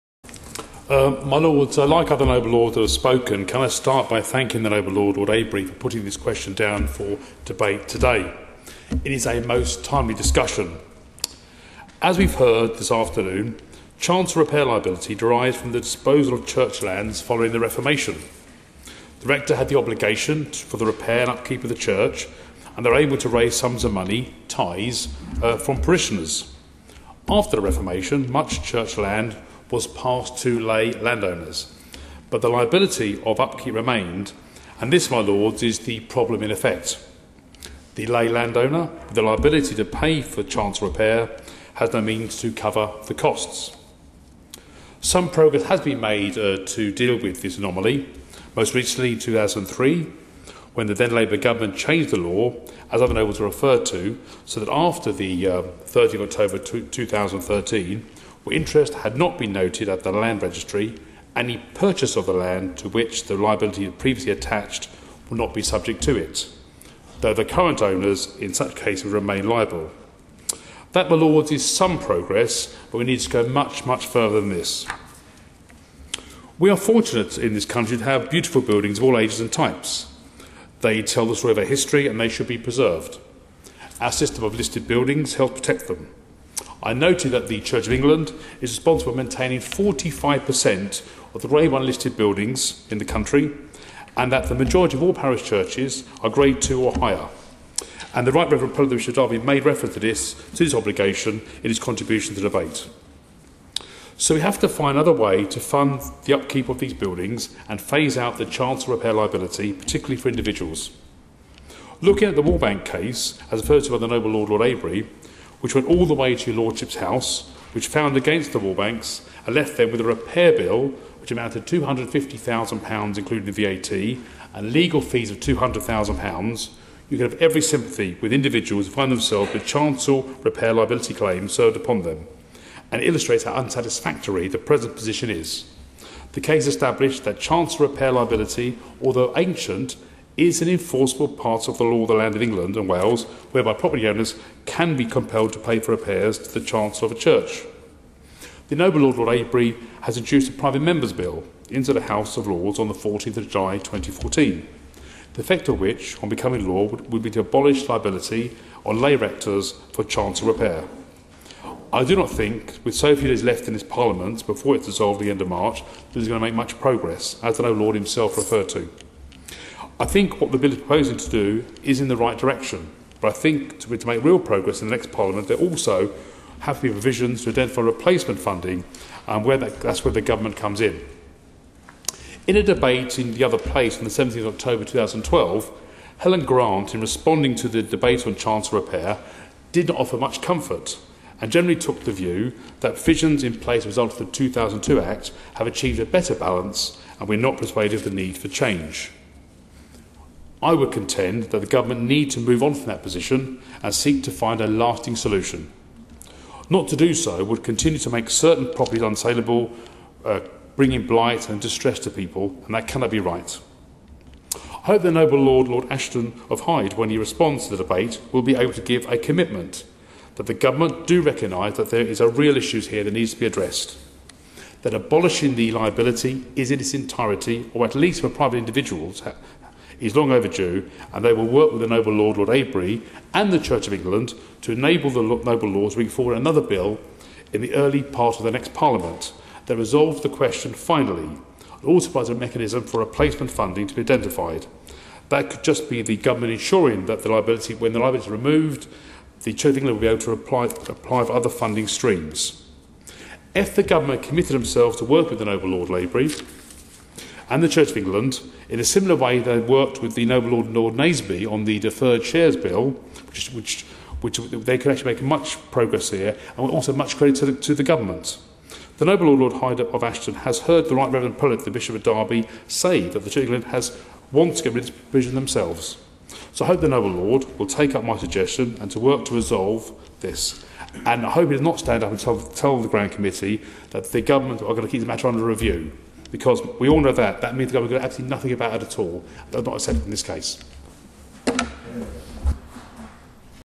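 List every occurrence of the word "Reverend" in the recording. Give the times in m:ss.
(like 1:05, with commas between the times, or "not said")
1:38, 4:31.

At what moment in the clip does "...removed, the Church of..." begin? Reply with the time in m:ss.
4:08.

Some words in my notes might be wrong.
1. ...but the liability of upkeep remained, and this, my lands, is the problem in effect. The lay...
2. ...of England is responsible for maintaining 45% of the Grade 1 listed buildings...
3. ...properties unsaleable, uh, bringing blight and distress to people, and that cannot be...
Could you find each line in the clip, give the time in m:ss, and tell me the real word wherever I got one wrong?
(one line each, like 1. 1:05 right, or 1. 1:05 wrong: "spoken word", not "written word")
1. 0:32 wrong: "lords", not "lands"
2. 1:27 right
3. 3:28 right.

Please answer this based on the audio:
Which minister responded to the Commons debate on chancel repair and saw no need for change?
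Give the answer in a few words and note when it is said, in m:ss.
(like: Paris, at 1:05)
Helen Grant, at 3:06.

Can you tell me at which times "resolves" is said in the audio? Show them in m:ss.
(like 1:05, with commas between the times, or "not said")
3:59, 4:39.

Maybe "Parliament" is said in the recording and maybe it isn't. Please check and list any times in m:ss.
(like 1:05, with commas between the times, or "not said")
2:43, 2:55, 3:58.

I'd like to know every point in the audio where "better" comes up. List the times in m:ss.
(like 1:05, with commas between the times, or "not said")
3:16.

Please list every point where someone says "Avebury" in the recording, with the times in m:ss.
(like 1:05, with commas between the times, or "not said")
0:05, 1:54, 2:29, 3:52.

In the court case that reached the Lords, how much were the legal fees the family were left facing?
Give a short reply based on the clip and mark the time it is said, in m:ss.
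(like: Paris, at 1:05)
£200,000, at 2:05.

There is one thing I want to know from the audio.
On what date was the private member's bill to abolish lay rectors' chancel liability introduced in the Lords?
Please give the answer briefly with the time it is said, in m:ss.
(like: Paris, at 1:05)
14 July 2014, at 2:32.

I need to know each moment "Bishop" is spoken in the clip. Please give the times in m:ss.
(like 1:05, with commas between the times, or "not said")
1:38, 4:31.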